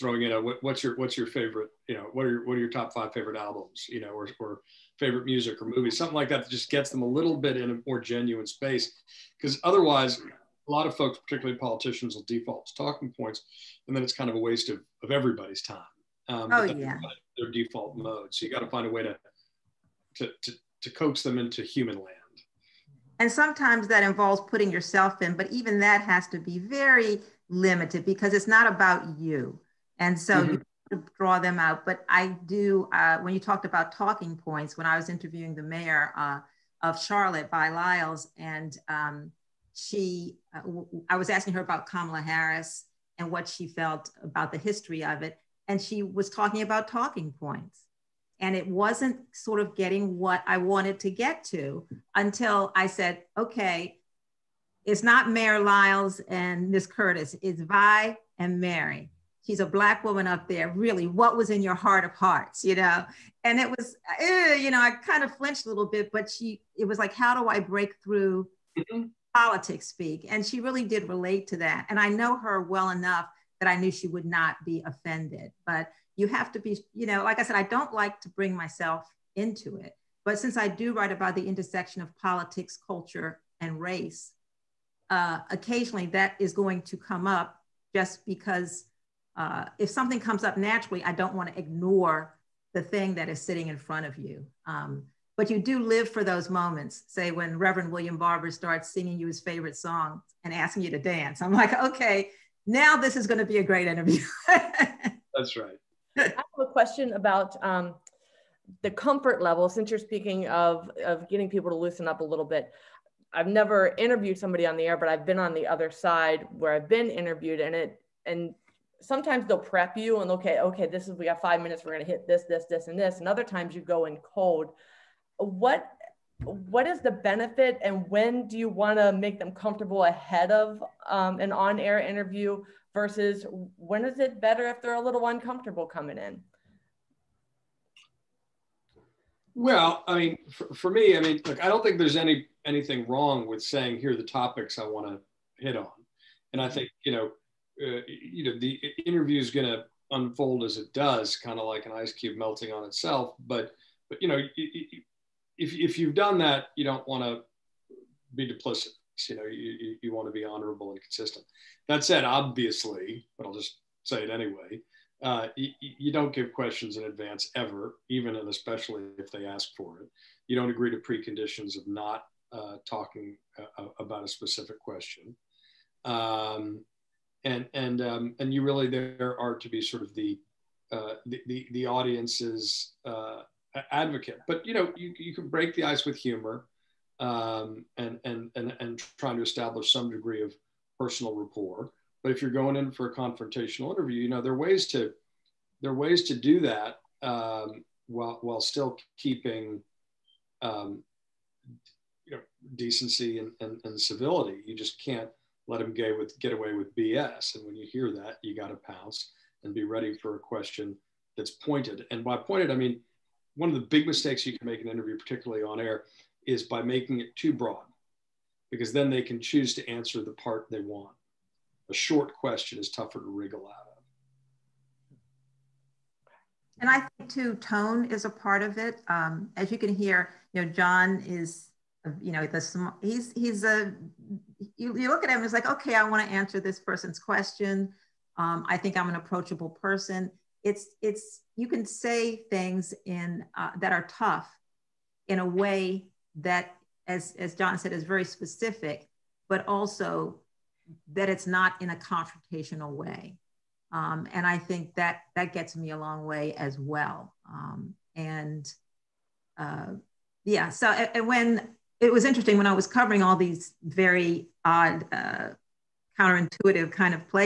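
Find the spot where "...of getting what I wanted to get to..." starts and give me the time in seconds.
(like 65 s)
49 s.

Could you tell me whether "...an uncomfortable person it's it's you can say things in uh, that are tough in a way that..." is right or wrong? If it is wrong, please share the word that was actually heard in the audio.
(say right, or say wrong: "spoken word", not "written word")
wrong: "approachable", not "uncomfortable".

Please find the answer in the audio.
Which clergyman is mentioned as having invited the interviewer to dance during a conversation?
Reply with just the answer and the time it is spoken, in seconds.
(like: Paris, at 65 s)
Reverend William Barber, at 97 s.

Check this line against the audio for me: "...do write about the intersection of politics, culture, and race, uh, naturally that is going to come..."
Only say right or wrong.
wrong.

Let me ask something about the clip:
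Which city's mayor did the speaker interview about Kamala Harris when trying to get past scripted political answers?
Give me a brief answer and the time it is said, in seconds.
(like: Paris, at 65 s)
Charlotte, at 36 s.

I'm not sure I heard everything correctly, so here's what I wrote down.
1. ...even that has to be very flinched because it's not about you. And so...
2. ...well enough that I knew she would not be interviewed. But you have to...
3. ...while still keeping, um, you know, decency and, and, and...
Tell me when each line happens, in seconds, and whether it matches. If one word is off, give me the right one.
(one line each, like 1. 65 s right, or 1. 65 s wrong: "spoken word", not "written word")
1. 25 s wrong: "limited", not "flinched"
2. 72 s wrong: "offended", not "interviewed"
3. 198 s right.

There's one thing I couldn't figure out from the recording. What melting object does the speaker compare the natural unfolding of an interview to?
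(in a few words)
An ice cube.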